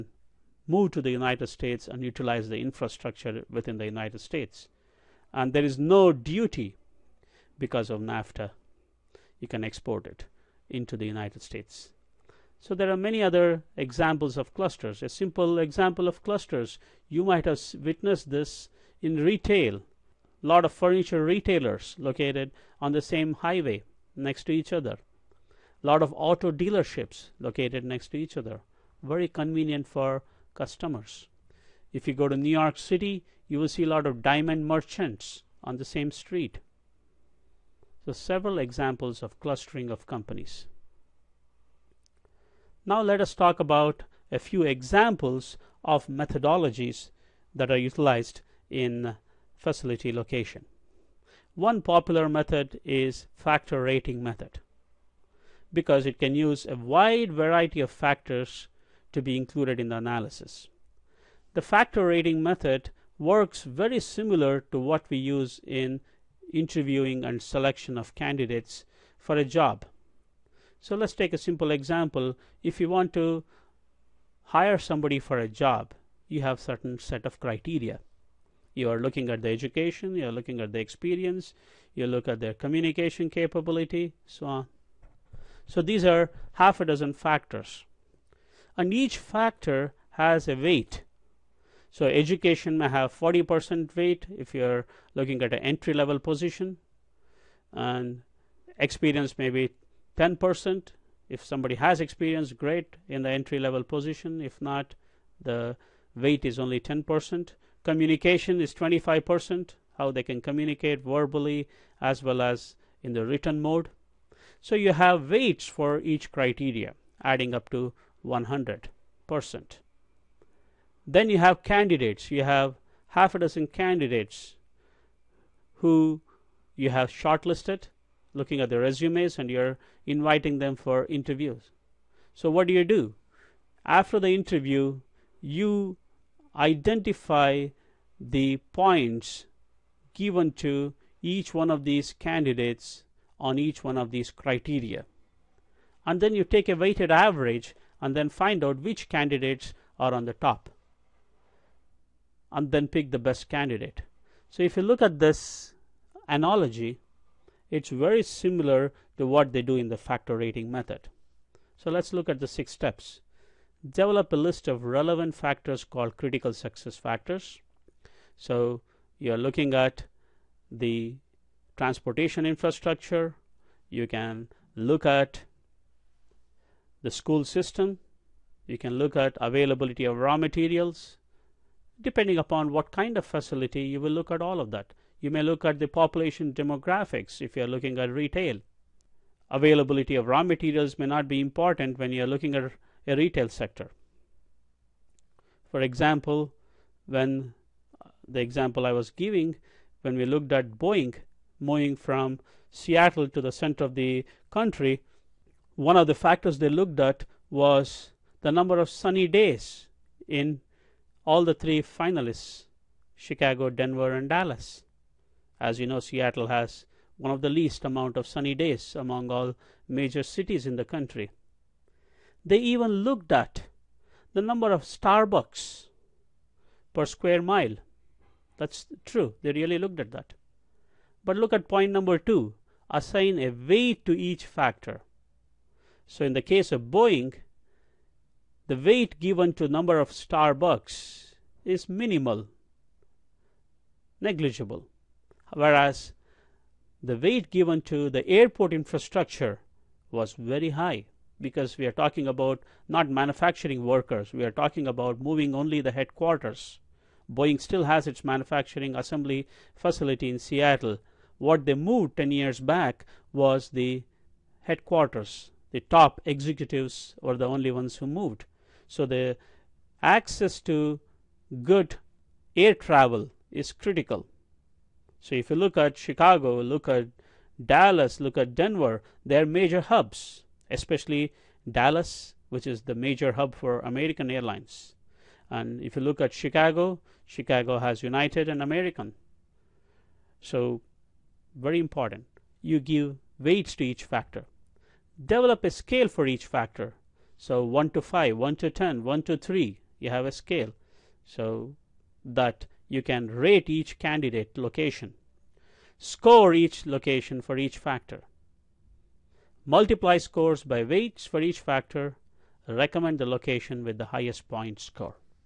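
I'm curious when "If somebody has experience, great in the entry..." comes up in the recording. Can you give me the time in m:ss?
1:41.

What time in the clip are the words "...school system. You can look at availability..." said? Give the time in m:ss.
2:57.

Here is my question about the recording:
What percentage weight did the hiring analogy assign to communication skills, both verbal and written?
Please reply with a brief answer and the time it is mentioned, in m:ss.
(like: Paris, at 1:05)
25%, at 1:48.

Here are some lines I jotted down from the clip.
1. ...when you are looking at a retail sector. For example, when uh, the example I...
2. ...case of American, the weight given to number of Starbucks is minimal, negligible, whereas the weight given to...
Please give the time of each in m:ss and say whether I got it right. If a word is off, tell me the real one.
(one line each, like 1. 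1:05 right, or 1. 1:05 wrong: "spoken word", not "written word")
1. 3:11 right
2. 3:56 wrong: "Boeing", not "American".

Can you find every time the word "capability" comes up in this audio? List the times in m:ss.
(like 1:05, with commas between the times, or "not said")
1:23.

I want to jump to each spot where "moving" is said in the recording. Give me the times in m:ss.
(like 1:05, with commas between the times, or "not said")
3:21, 4:15.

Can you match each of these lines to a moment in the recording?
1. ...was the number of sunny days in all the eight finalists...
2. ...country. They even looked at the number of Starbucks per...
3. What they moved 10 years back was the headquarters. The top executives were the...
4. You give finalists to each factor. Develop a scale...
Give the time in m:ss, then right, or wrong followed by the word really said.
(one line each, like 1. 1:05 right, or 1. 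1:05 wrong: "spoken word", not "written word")
1. 3:27 wrong: "three", not "eight"
2. 3:40 right
3. 4:21 right
4. 4:52 wrong: "weights", not "finalists".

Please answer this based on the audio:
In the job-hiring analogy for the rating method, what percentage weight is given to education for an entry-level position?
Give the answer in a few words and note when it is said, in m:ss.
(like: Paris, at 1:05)
40%, at 1:33.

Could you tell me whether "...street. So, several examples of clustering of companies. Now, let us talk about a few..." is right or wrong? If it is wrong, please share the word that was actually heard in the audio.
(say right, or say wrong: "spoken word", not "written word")
right.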